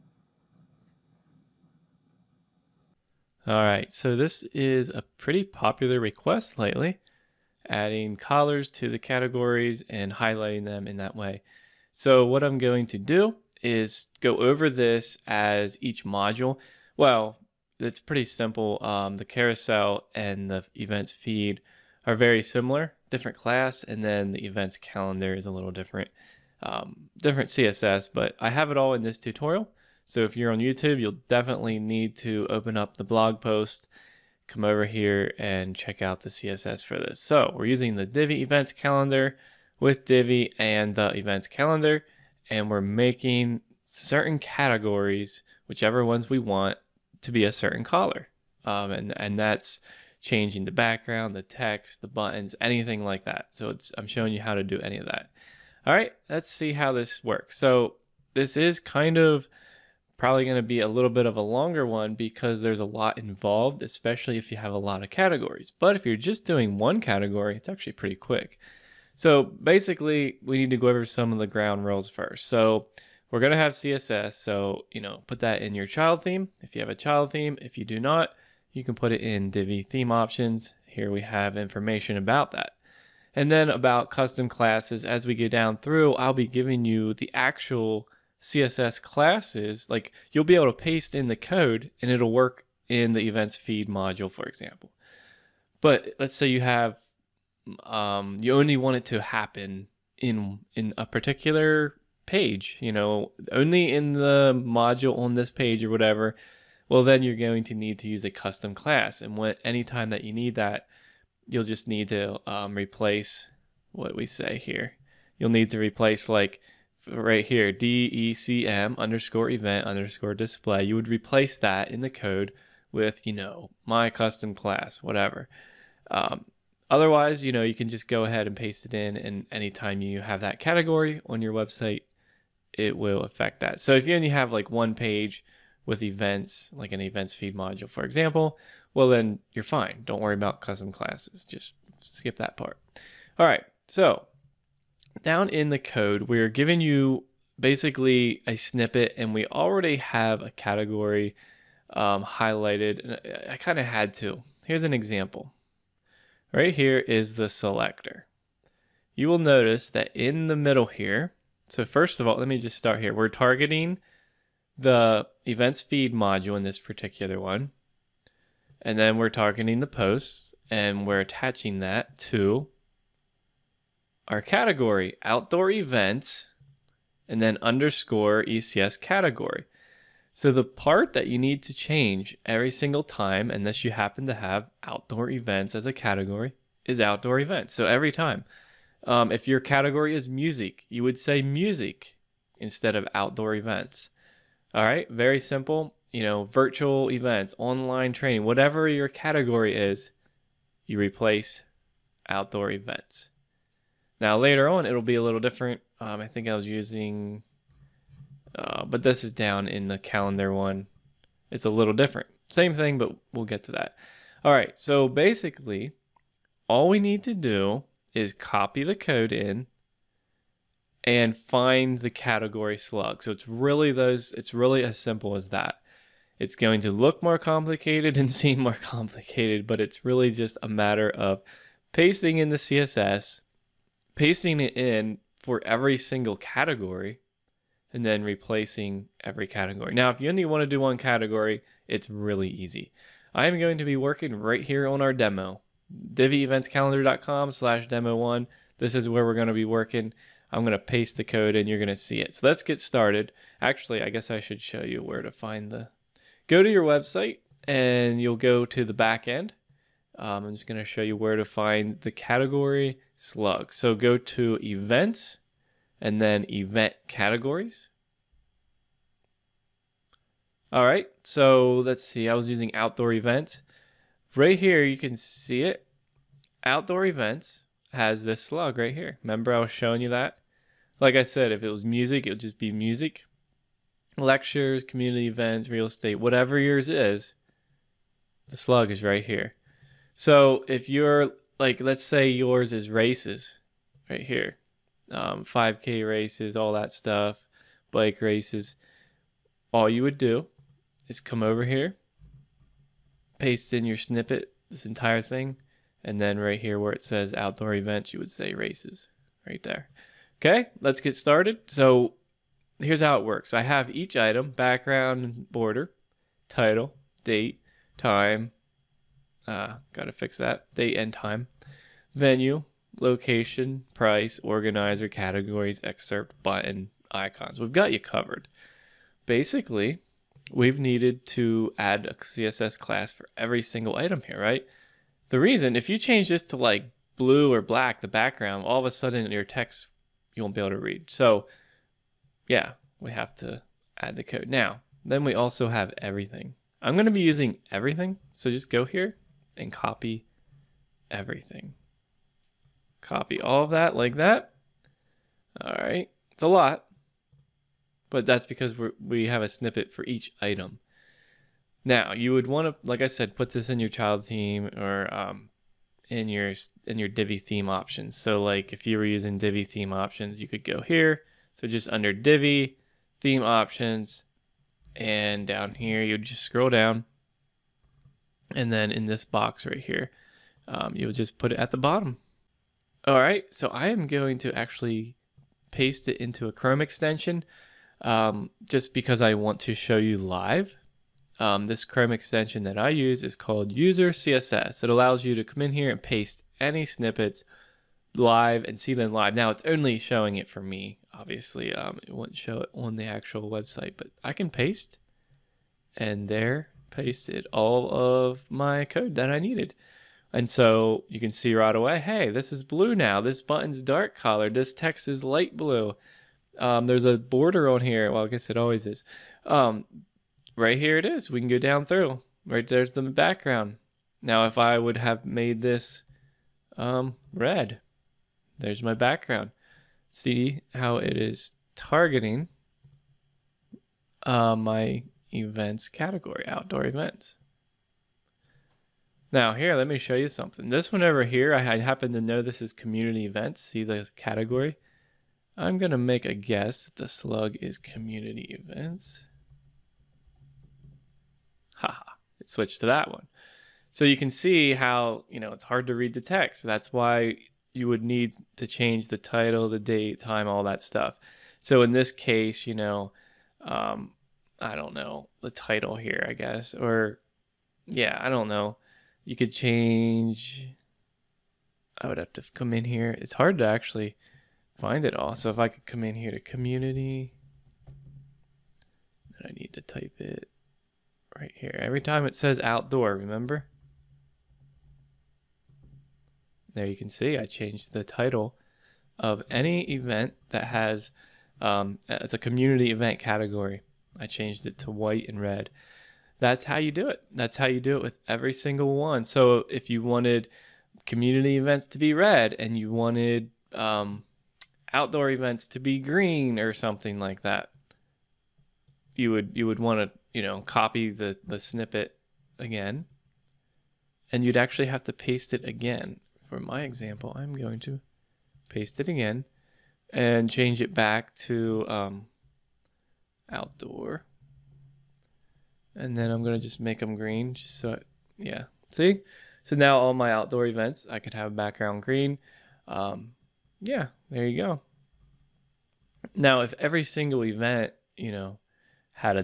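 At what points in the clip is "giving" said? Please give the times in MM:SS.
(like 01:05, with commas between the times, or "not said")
01:26, 02:26.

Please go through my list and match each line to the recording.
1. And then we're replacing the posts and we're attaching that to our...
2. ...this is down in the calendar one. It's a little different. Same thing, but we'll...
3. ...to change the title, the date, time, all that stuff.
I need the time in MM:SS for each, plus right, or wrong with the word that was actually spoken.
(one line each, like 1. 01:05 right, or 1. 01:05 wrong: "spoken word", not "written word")
1. 02:48 wrong: "targeting", not "replacing"
2. 03:29 right
3. 07:38 right.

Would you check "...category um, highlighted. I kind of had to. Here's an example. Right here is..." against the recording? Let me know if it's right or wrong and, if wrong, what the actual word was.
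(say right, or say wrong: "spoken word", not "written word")
right.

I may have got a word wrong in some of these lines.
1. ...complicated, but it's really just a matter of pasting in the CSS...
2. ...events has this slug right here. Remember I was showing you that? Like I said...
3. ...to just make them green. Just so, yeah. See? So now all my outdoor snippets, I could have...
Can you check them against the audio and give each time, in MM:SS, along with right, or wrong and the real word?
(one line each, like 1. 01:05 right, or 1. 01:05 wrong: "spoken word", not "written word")
1. 03:48 right
2. 04:37 right
3. 08:46 wrong: "events", not "snippets".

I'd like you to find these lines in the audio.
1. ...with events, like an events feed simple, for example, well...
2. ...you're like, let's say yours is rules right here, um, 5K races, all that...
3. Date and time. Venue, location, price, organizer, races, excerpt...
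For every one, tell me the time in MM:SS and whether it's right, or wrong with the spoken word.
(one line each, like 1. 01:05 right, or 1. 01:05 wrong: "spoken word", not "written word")
1. 02:15 wrong: "module", not "simple"
2. 04:50 wrong: "races", not "rules"
3. 05:20 wrong: "categories", not "races".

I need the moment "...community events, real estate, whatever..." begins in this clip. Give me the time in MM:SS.
04:44.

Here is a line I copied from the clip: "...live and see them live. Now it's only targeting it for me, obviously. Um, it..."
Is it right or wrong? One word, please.
wrong.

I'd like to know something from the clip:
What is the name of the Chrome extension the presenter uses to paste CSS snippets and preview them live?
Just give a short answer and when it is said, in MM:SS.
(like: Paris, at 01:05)
User CSS, at 06:33.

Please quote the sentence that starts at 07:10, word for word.
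See how it is targeting uh, my events category, outdoor events.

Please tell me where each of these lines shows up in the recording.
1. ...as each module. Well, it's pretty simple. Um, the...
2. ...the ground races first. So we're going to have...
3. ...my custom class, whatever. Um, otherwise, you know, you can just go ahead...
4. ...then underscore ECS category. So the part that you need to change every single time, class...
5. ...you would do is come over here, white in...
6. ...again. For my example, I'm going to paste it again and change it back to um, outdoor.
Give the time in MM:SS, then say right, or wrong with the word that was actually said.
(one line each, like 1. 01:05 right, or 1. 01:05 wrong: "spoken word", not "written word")
1. 00:15 right
2. 01:11 wrong: "rules", not "races"
3. 02:03 right
4. 02:57 wrong: "unless", not "class"
5. 04:59 wrong: "paste", not "white"
6. 08:35 right.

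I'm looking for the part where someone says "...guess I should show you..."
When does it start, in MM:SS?
04:14.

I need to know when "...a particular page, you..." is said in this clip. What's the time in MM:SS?
01:40.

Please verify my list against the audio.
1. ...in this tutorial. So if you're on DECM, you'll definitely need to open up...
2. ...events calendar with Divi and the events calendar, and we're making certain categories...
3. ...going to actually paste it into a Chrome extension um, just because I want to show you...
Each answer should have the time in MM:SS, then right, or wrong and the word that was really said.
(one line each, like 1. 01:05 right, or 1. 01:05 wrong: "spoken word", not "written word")
1. 00:28 wrong: "YouTube", not "DECM"
2. 00:38 right
3. 06:24 right.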